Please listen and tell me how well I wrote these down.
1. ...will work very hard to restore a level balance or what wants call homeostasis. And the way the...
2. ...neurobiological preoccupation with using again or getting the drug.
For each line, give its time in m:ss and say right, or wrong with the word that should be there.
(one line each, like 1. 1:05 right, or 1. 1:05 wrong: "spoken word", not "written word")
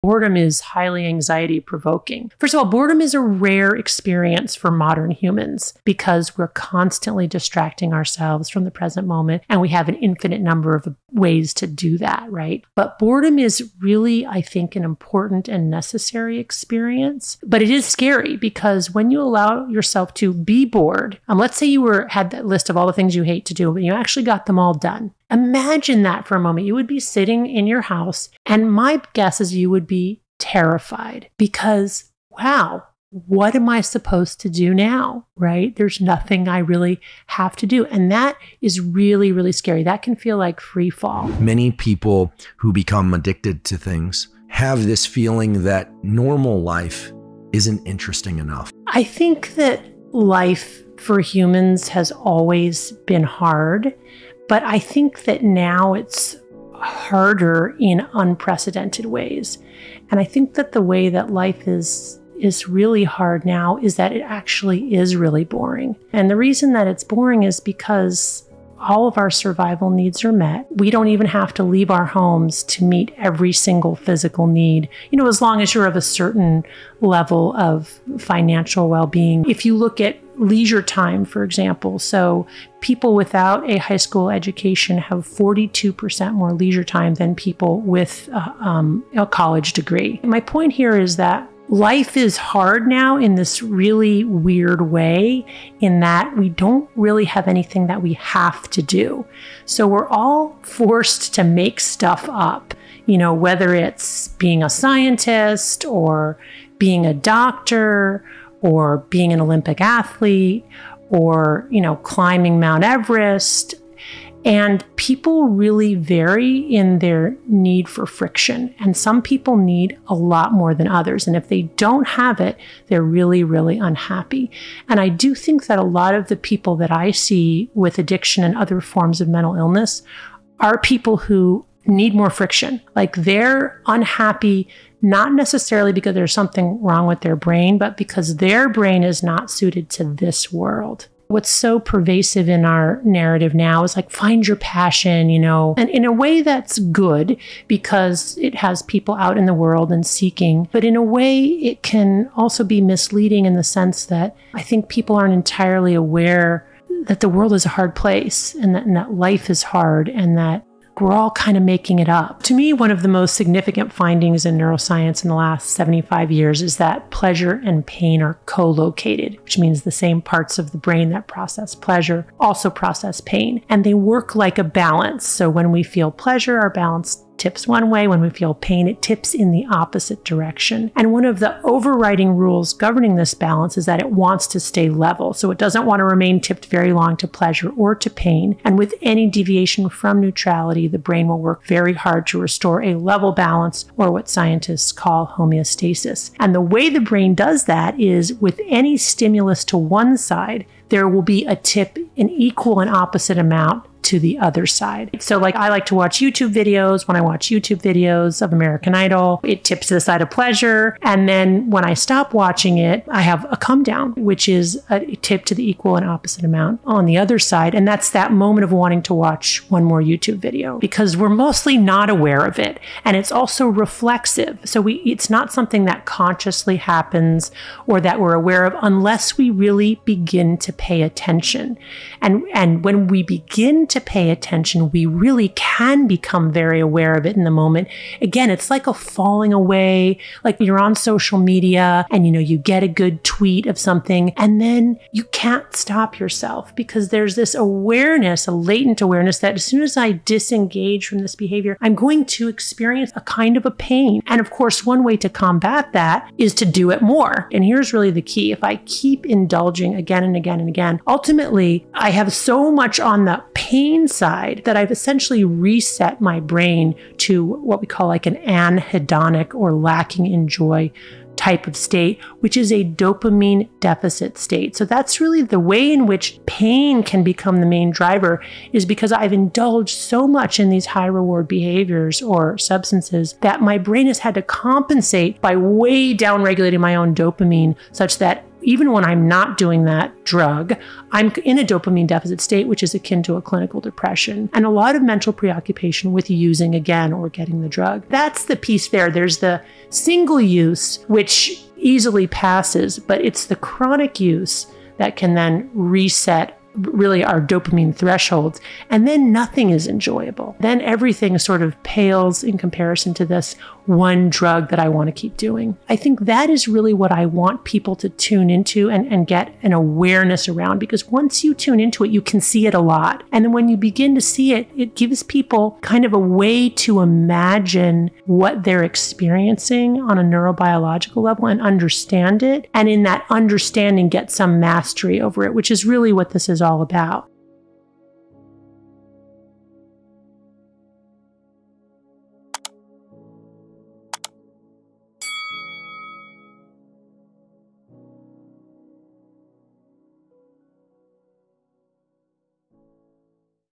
1. 3:11 wrong: "scientists", not "wants"
2. 4:55 wrong: "mental", not "neurobiological".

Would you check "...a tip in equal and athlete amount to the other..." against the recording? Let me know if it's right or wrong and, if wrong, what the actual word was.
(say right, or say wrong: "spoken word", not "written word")
wrong: "opposite", not "athlete".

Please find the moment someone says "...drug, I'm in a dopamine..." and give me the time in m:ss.
4:50.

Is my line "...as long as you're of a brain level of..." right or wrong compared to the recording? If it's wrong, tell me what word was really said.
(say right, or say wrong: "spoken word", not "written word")
wrong: "certain", not "brain".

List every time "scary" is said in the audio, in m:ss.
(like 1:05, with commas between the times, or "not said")
0:17, 0:39.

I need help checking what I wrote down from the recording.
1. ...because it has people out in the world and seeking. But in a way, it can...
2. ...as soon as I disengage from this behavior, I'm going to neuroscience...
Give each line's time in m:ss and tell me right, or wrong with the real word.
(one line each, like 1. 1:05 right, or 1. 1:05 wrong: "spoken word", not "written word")
1. 2:27 right
2. 4:09 wrong: "experience", not "neuroscience".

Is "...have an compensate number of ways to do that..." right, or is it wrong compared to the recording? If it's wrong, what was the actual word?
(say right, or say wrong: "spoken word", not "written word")
wrong: "infinite", not "compensate".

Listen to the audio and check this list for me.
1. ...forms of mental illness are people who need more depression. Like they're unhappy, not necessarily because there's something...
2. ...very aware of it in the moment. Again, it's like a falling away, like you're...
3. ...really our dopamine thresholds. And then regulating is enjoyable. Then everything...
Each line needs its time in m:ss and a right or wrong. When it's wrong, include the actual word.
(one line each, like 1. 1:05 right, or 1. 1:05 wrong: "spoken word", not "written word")
1. 2:08 wrong: "friction", not "depression"
2. 3:56 right
3. 5:06 wrong: "nothing", not "regulating".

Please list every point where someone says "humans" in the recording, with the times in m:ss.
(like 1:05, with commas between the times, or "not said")
0:05, 0:51.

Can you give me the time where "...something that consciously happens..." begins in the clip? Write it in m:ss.
3:45.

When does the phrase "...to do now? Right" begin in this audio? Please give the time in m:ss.
0:34.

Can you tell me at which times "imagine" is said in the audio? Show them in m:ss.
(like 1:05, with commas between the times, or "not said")
0:25, 5:27.